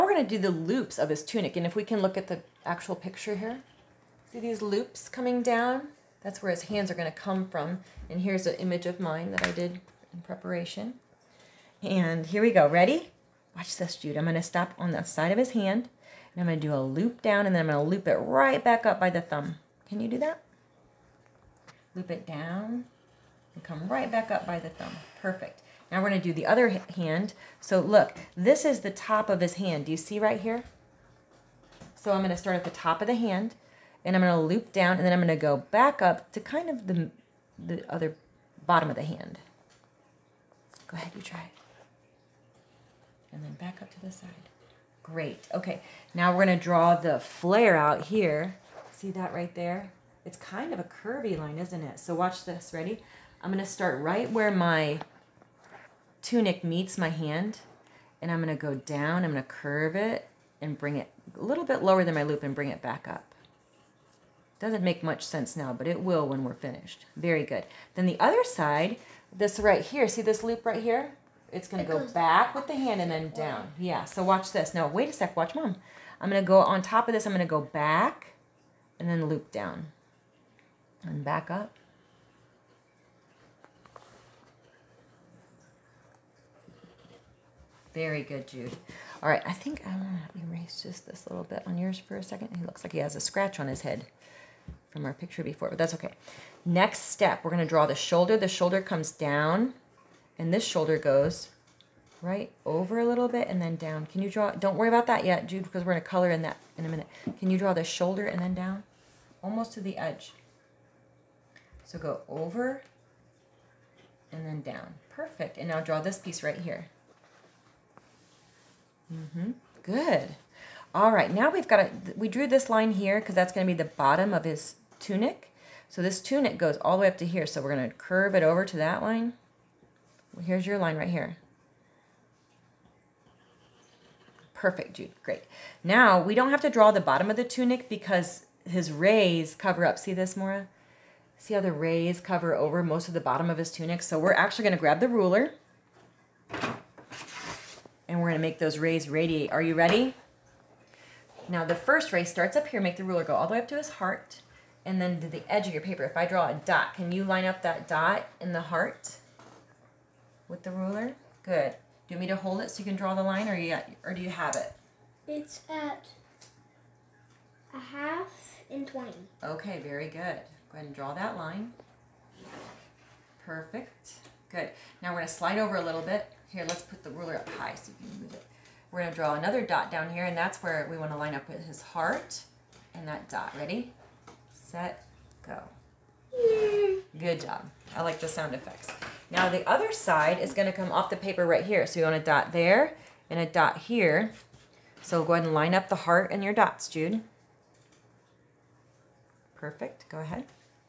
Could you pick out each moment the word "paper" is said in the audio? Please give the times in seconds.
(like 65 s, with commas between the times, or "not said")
155 s, 191 s.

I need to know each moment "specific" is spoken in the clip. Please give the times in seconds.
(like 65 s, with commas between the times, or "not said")
not said.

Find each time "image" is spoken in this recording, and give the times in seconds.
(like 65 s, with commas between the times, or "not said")
8 s.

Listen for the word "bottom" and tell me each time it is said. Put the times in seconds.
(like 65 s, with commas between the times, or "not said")
38 s, 123 s, 137 s, 143 s.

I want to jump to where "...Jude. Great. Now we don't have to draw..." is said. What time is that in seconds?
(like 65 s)
134 s.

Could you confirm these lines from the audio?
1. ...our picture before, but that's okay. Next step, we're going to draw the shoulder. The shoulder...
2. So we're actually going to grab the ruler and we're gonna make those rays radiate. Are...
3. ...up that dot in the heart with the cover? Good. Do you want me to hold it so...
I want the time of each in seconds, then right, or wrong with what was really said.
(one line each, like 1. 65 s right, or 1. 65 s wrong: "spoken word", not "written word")
1. 95 s right
2. 144 s right
3. 157 s wrong: "ruler", not "cover".